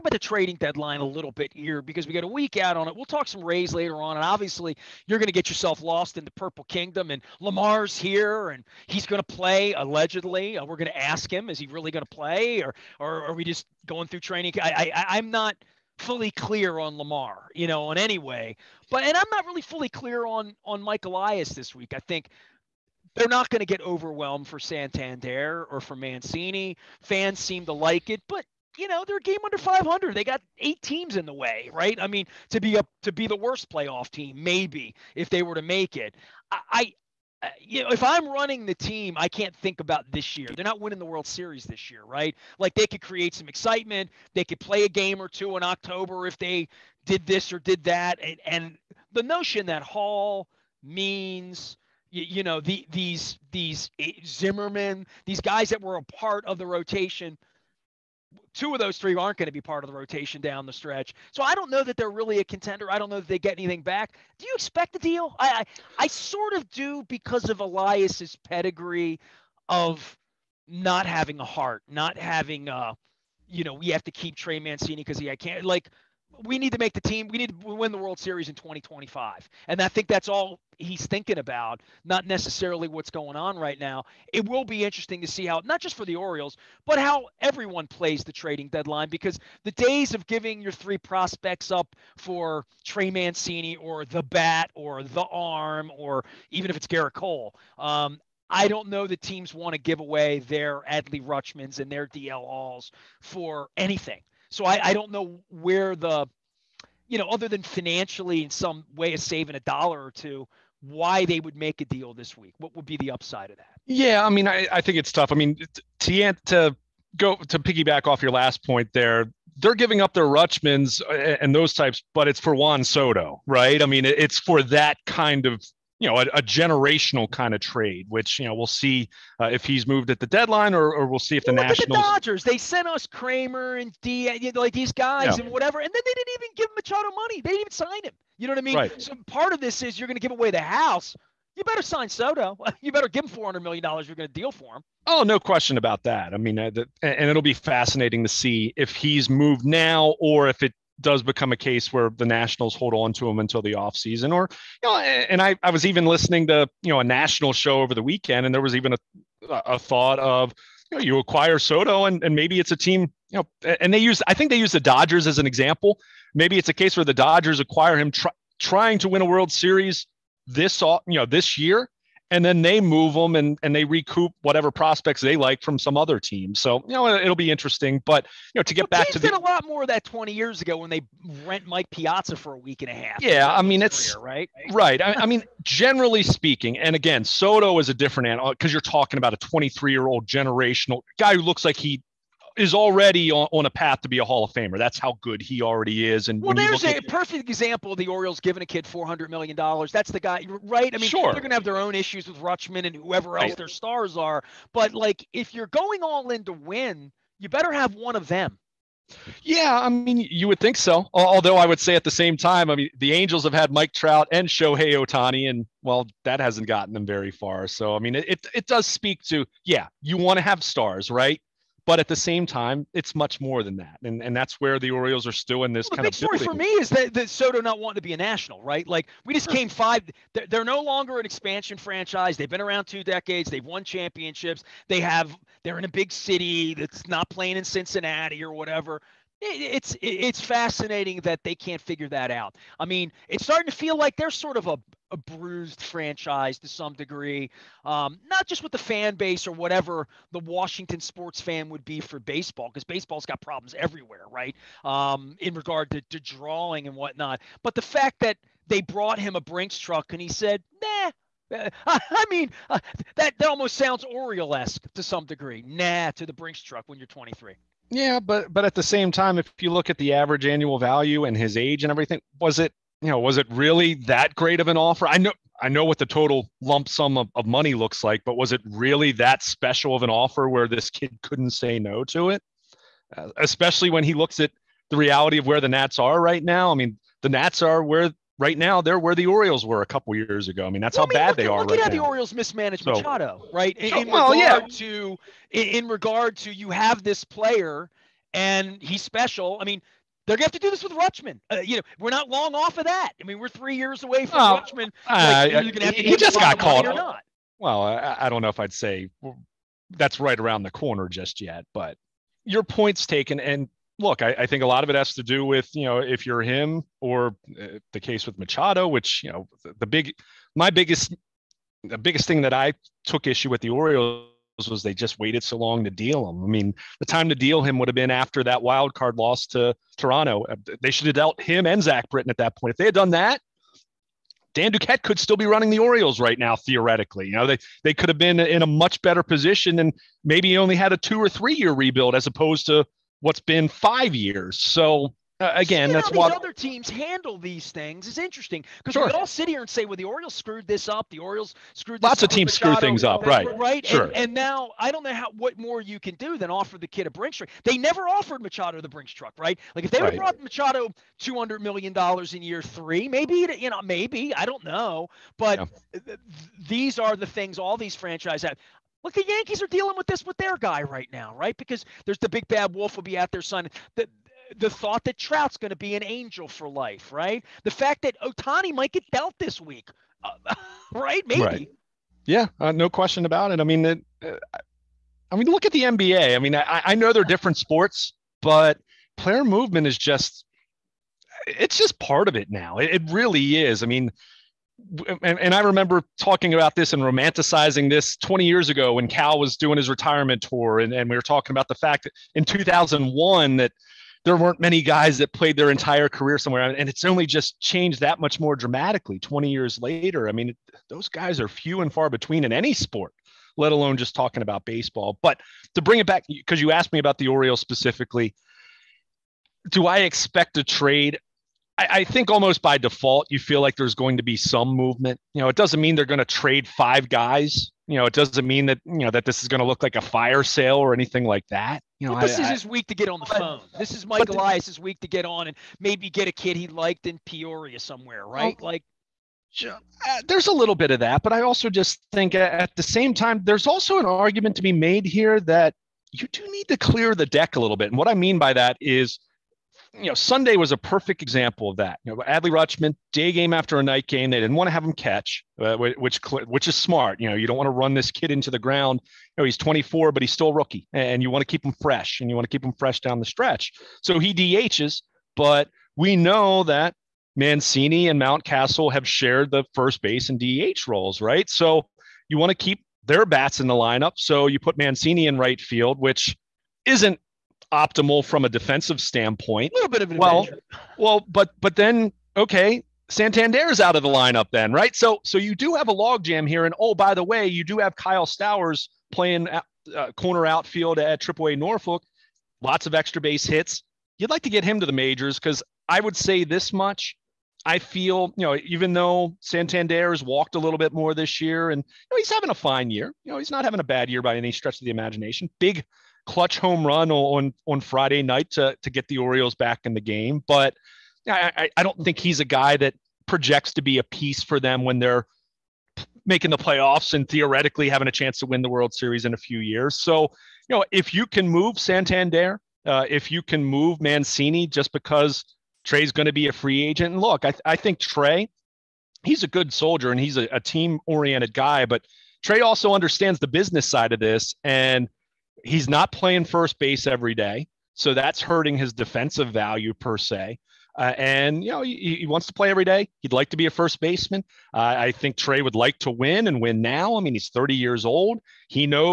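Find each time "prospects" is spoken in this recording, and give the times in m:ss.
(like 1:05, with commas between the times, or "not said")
1:30, 2:54.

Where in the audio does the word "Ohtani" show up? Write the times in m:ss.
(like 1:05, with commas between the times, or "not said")
3:34, 6:18.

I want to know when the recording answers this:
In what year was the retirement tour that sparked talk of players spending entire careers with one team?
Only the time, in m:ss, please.
6:42.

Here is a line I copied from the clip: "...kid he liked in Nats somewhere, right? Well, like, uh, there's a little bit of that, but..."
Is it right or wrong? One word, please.
wrong.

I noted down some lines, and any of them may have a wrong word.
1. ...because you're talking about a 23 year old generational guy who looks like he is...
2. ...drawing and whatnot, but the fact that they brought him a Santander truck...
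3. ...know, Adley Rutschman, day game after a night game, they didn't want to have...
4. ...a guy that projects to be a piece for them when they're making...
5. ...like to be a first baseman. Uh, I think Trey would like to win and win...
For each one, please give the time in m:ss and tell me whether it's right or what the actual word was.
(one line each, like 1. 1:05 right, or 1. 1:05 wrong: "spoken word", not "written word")
1. 3:08 right
2. 4:16 wrong: "Brinks", not "Santander"
3. 7:32 right
4. 8:32 right
5. 9:03 right.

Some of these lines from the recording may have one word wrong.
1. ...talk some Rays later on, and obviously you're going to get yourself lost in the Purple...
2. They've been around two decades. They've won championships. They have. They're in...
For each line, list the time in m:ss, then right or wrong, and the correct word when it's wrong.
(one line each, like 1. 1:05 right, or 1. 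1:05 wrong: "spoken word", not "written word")
1. 0:03 right
2. 3:52 right.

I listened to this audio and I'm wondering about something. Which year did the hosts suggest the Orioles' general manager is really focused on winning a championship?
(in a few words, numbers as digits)
2025.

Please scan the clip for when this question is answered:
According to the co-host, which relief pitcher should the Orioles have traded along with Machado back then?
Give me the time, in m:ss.
5:31.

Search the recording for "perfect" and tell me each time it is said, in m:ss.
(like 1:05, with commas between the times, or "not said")
3:17, 7:30.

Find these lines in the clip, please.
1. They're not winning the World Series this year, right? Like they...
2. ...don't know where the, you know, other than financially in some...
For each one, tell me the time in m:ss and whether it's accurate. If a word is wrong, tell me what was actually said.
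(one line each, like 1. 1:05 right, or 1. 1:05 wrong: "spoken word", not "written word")
1. 0:40 right
2. 1:44 right.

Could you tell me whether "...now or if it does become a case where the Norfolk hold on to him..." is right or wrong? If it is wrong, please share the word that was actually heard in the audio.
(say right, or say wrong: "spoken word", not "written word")
wrong: "Nationals", not "Norfolk".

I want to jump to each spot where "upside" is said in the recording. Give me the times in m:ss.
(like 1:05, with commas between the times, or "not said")
1:53.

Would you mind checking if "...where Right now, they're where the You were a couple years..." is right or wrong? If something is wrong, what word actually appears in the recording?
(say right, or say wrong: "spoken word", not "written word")
wrong: "Orioles", not "You".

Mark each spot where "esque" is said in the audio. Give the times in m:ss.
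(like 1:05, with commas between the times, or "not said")
4:24.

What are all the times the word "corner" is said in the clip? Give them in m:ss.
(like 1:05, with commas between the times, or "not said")
5:10, 8:10.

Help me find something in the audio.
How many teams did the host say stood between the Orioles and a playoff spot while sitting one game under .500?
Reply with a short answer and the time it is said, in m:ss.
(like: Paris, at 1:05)
8, at 0:30.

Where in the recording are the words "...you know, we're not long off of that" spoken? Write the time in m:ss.
5:01.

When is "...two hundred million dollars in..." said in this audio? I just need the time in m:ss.
6:01.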